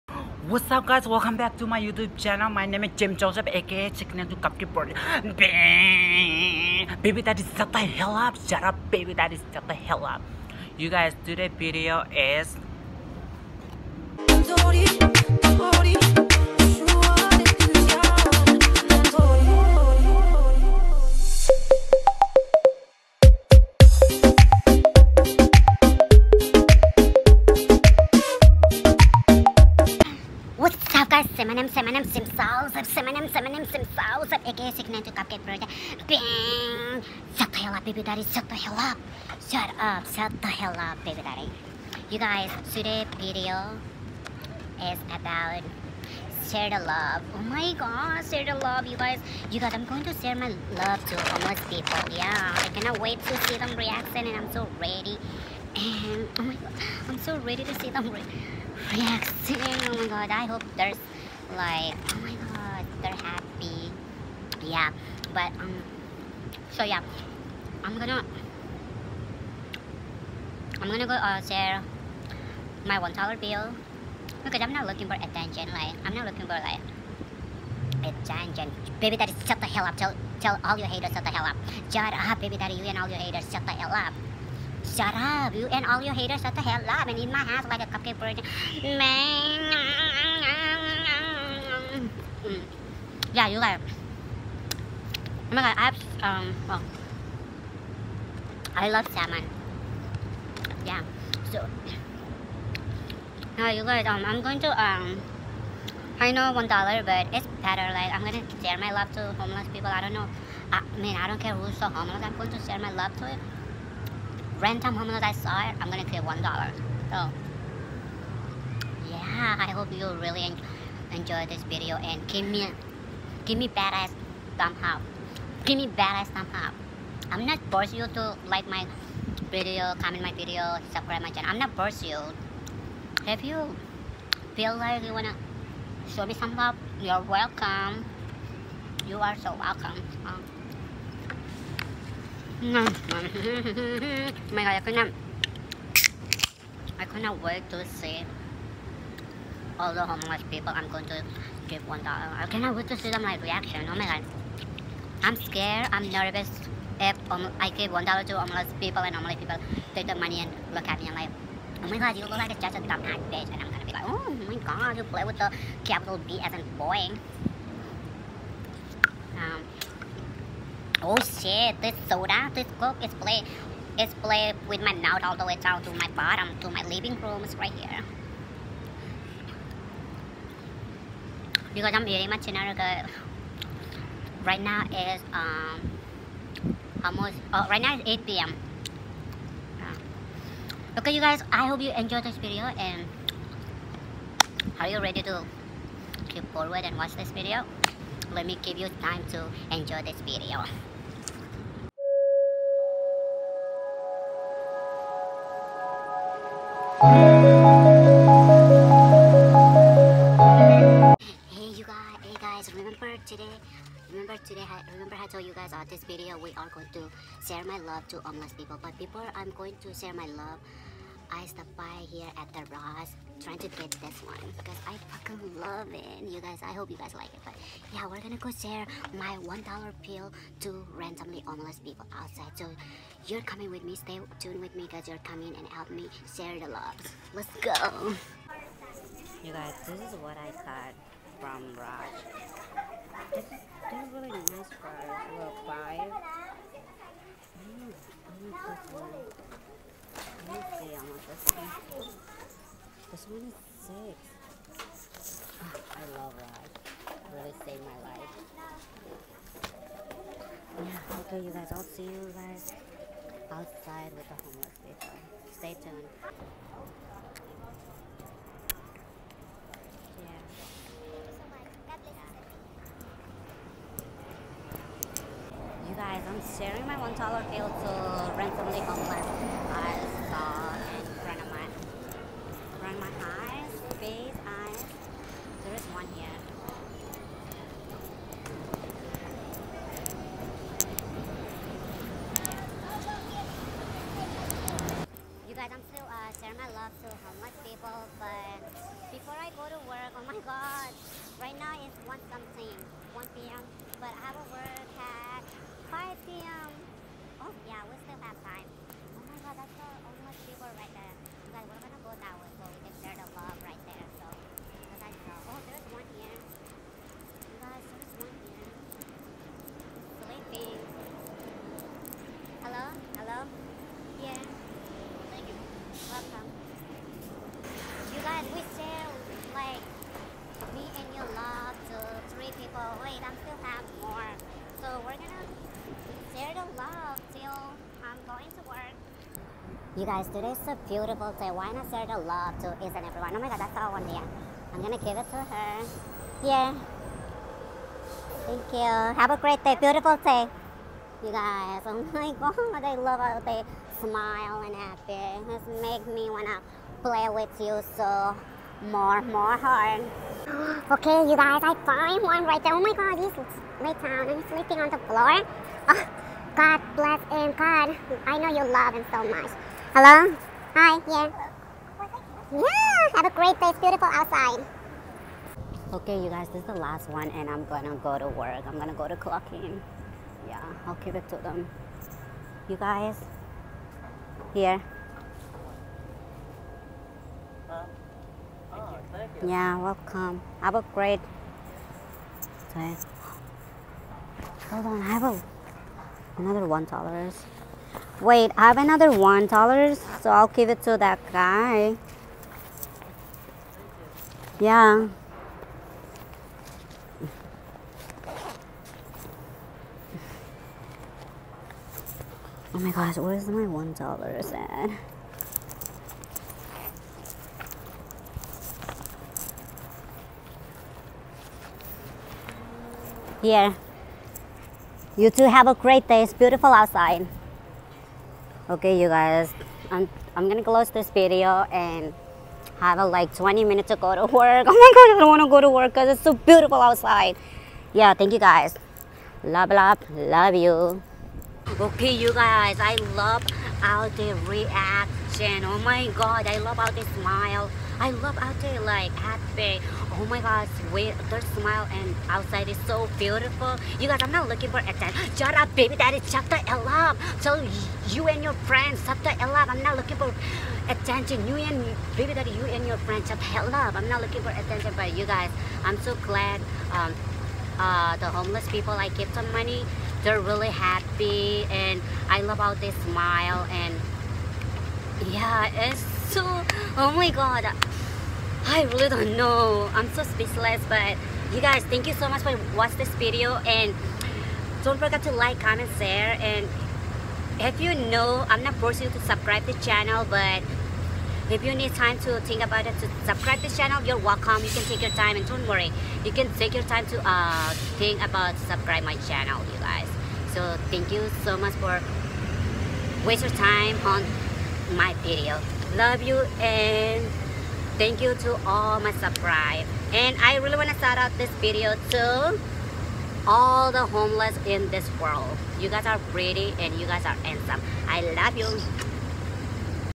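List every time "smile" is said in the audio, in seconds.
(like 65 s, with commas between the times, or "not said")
354 s, 447 s, 451 s, 472 s.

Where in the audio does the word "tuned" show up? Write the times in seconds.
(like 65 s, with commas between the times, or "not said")
234 s, 265 s.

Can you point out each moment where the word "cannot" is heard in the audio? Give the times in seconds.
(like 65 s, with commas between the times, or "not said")
52 s, 152 s.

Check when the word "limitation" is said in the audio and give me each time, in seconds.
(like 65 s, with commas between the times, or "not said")
not said.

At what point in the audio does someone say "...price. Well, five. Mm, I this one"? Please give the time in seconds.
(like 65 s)
244 s.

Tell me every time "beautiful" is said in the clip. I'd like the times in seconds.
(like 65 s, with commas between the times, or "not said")
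340 s, 349 s, 373 s, 426 s, 436 s, 453 s.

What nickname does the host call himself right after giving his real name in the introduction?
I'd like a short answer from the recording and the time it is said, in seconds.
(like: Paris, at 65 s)
Chicken to Cupcake Bird, at 3 s.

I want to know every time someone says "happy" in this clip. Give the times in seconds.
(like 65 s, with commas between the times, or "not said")
63 s, 354 s, 449 s, 470 s.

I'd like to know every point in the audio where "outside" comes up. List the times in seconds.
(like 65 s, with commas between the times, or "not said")
232 s, 263 s, 374 s, 426 s, 436 s, 452 s.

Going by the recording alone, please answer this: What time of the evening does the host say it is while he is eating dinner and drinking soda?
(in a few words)
8 p.m.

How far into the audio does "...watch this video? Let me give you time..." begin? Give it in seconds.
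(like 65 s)
196 s.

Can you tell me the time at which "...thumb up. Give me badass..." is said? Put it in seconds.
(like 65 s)
124 s.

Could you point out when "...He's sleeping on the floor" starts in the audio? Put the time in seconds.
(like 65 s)
364 s.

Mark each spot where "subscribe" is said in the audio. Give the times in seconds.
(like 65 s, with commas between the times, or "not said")
130 s, 489 s, 493 s, 498 s, 509 s.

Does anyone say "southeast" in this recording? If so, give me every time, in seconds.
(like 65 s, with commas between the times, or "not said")
not said.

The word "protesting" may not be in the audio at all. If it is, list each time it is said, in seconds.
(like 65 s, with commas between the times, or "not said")
not said.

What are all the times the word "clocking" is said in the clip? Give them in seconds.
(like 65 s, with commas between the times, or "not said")
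379 s.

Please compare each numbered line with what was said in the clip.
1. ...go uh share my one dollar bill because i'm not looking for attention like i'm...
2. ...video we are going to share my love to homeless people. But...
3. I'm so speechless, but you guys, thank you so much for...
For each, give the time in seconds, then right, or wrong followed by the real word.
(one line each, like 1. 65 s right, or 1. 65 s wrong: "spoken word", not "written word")
1. 71 s right
2. 216 s right
3. 479 s right.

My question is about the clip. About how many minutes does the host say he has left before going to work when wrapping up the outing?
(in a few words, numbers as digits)
20 minutes.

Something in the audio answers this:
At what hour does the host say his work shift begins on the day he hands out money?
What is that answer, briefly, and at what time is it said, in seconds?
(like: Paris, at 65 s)
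5 p.m., at 305 s.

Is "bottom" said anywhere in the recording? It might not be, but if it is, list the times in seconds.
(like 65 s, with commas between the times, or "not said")
176 s.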